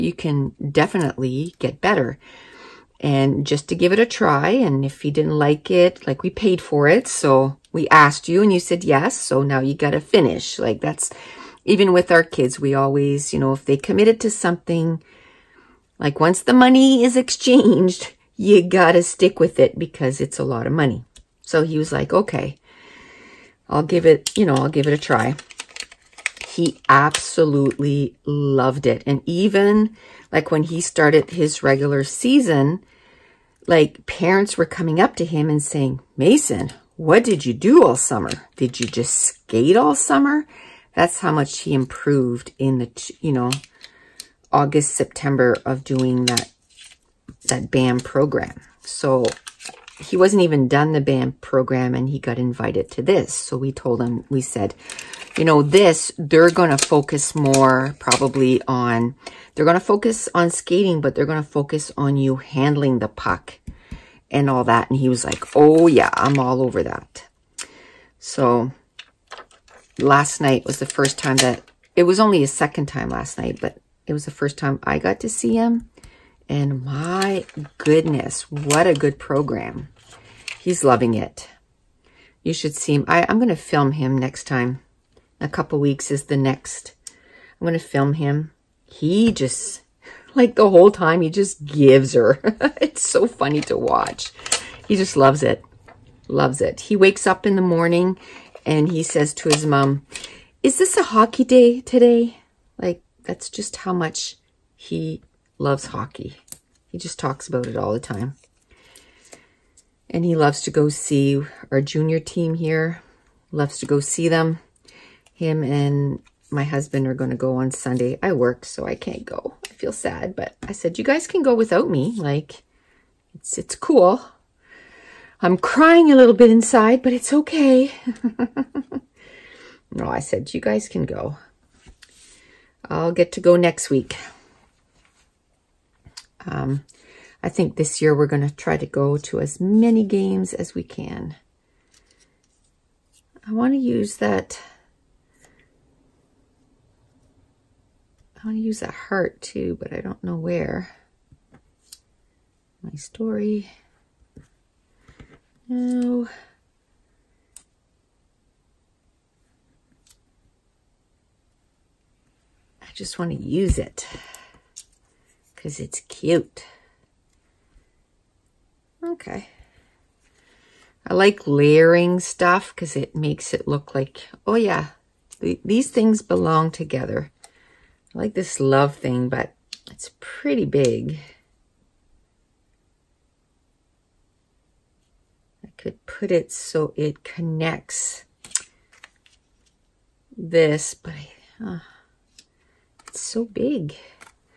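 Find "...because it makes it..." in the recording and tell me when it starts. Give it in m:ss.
2:52.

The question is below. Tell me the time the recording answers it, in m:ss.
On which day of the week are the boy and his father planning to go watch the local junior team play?
1:57.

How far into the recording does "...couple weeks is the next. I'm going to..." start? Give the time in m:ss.
1:25.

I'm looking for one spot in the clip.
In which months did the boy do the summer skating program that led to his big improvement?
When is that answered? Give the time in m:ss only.
0:44.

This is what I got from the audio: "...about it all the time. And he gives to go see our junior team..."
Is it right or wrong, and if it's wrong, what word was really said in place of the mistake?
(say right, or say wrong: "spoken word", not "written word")
wrong: "loves", not "gives".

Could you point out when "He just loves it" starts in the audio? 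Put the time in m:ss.
1:34.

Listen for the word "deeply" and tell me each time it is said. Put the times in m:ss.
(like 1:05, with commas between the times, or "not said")
not said.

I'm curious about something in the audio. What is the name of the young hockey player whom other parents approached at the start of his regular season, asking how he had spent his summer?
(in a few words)
Mason.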